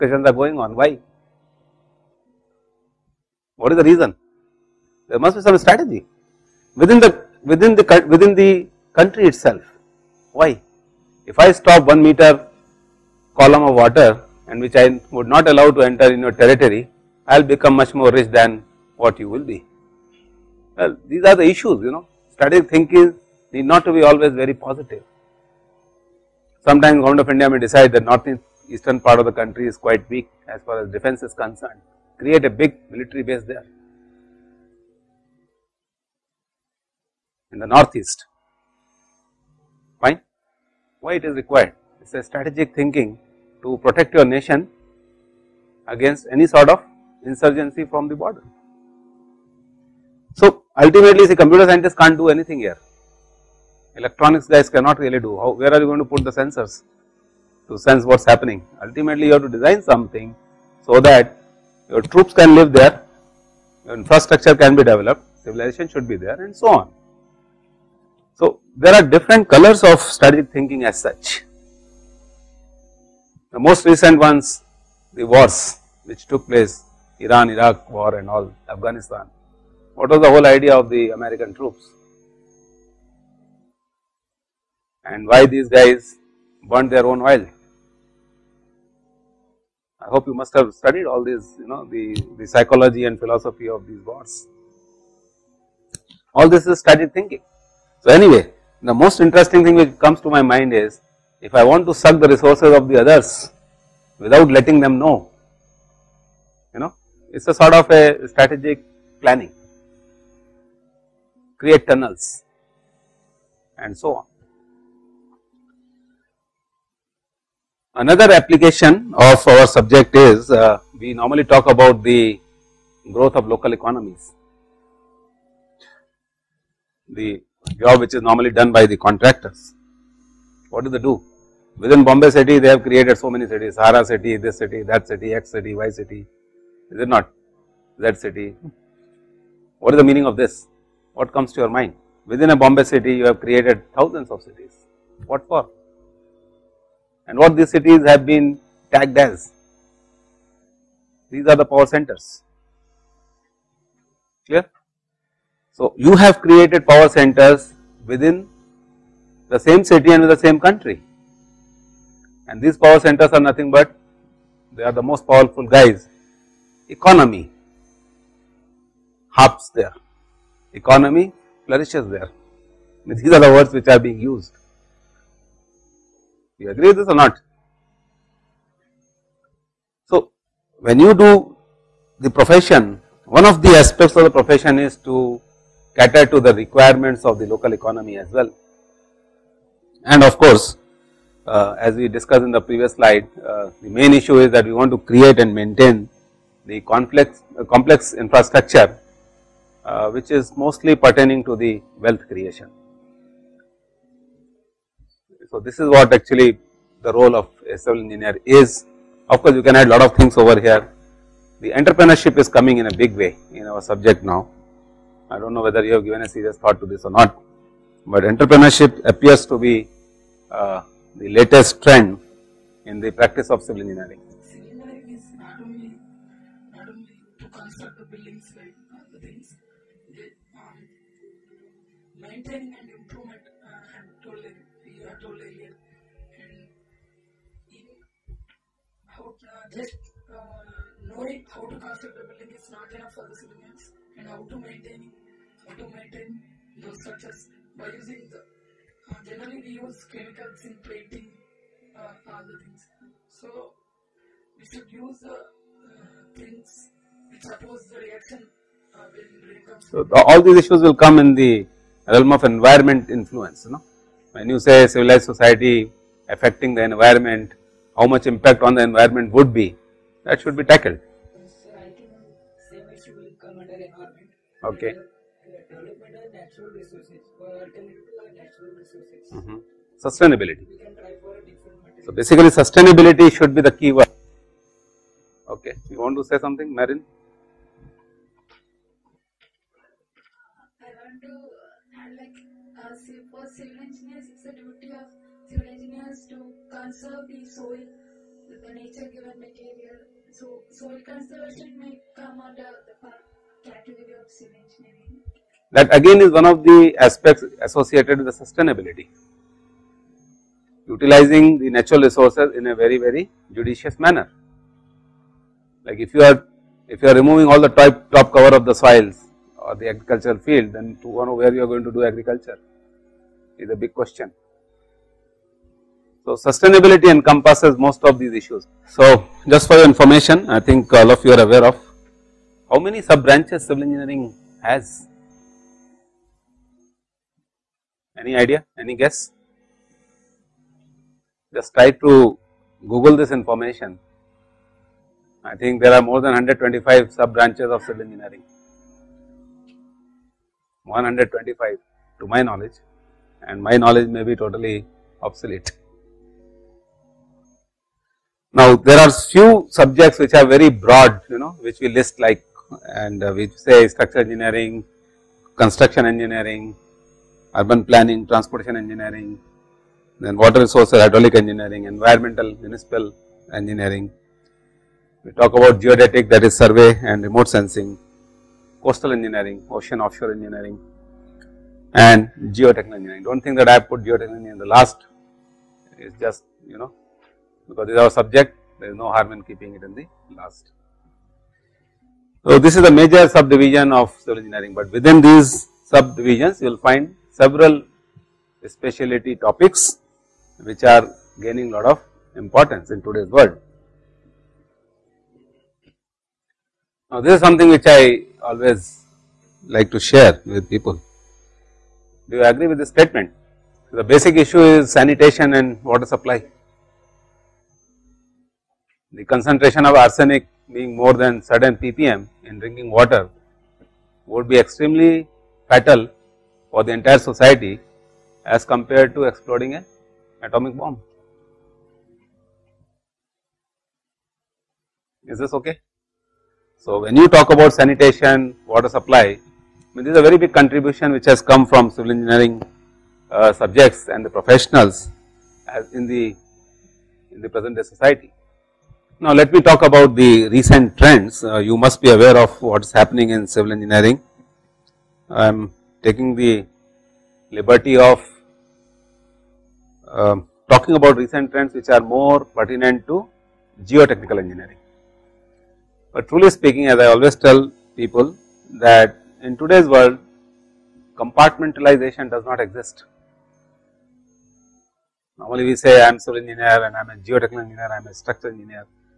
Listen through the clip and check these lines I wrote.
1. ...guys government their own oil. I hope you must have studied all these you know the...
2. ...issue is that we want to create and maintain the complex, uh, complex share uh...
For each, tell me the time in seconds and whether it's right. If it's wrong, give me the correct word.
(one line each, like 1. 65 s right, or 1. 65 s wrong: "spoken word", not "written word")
1. 85 s wrong: "burnt", not "government"
2. 194 s wrong: "infrastructure", not "share".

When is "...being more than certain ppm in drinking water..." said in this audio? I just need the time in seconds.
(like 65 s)
420 s.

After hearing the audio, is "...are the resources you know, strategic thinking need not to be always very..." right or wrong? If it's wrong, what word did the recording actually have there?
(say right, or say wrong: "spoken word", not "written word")
wrong: "issues", not "resources".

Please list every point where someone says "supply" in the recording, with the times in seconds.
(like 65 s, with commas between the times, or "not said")
416 s, 438 s.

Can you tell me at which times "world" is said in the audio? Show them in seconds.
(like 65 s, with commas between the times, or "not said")
403 s, 469 s.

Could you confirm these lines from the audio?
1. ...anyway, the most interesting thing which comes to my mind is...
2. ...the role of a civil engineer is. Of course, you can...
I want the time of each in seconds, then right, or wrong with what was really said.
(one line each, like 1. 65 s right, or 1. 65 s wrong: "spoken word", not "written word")
1. 98 s right
2. 207 s right.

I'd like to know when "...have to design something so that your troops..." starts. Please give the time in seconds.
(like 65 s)
59 s.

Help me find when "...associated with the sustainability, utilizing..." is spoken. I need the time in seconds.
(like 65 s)
307 s.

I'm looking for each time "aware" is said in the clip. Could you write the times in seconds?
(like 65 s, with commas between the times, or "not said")
331 s, 452 s.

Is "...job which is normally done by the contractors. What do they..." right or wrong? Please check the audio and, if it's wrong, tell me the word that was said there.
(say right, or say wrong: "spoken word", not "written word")
right.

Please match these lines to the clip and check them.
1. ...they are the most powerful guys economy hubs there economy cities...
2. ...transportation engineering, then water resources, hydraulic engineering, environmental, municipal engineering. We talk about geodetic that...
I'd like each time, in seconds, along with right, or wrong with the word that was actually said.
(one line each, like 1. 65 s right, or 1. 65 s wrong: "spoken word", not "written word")
1. 164 s wrong: "flourishes", not "cities"
2. 368 s right.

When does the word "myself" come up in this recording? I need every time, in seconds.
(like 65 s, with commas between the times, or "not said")
not said.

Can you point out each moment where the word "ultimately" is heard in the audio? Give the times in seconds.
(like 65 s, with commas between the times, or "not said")
50 s, 58 s.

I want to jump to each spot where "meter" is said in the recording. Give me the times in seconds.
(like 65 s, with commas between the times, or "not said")
12 s.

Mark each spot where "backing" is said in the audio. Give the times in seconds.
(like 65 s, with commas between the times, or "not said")
not said.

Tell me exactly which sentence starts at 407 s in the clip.
Now, this is something which I always like to share with people.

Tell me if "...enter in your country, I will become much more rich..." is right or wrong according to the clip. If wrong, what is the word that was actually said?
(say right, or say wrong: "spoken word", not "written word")
wrong: "territory", not "country".